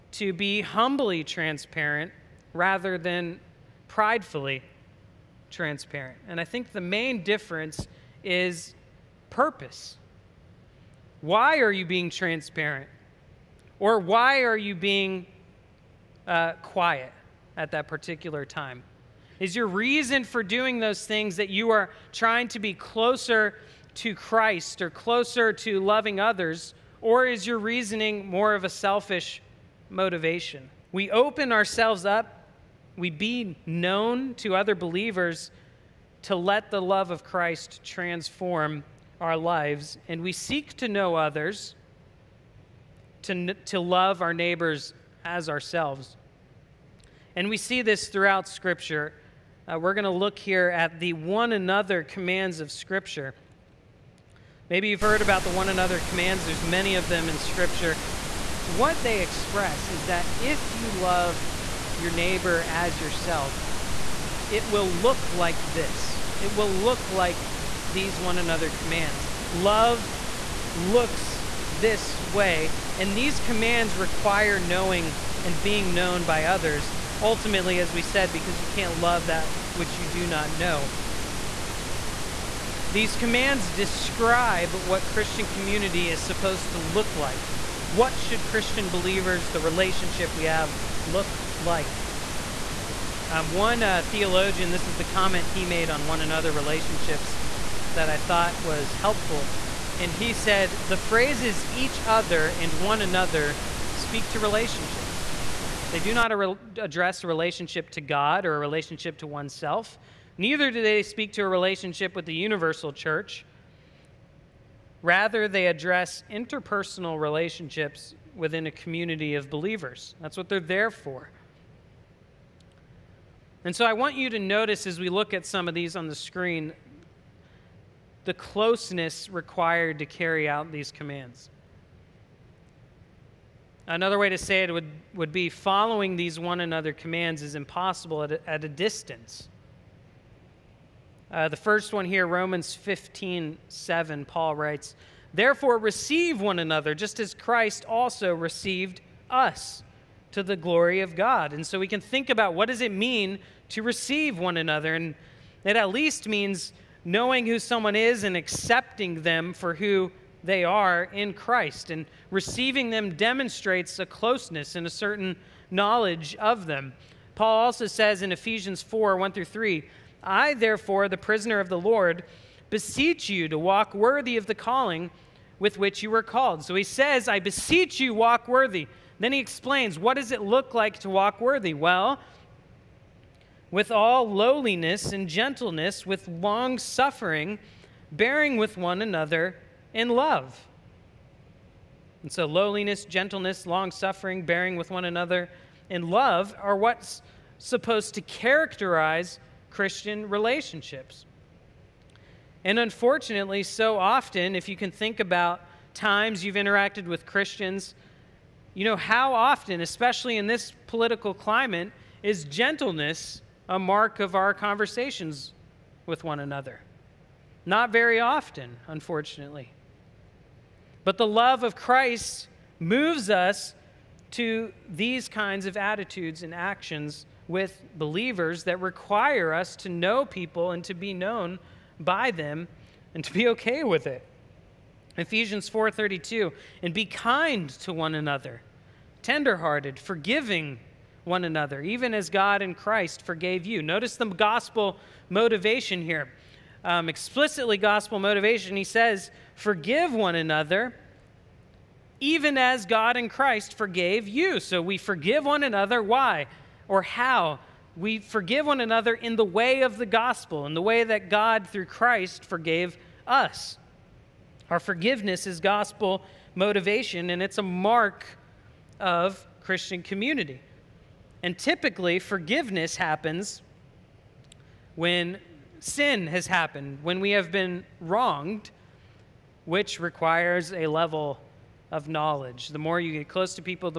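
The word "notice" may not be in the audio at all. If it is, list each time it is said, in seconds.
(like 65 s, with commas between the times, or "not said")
124 s, 243 s.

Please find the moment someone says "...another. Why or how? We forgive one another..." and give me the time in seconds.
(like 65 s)
255 s.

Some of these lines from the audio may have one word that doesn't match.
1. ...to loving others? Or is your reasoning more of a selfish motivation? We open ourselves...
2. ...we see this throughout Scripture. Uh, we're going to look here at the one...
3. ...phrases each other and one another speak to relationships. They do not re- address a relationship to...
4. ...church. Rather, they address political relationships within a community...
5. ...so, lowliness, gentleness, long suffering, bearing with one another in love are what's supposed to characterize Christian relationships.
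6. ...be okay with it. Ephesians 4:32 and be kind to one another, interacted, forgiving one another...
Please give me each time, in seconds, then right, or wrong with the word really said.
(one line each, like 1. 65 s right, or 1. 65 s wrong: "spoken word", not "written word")
1. 25 s right
2. 47 s right
3. 100 s right
4. 112 s wrong: "interpersonal", not "political"
5. 192 s right
6. 233 s wrong: "tenderhearted", not "interacted".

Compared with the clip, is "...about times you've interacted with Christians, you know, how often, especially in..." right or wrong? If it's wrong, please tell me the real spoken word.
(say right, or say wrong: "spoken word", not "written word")
right.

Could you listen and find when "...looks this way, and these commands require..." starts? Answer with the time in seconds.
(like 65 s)
70 s.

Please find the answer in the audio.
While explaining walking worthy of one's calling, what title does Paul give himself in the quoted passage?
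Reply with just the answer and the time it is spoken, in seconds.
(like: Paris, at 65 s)
The prisoner of the Lord, at 171 s.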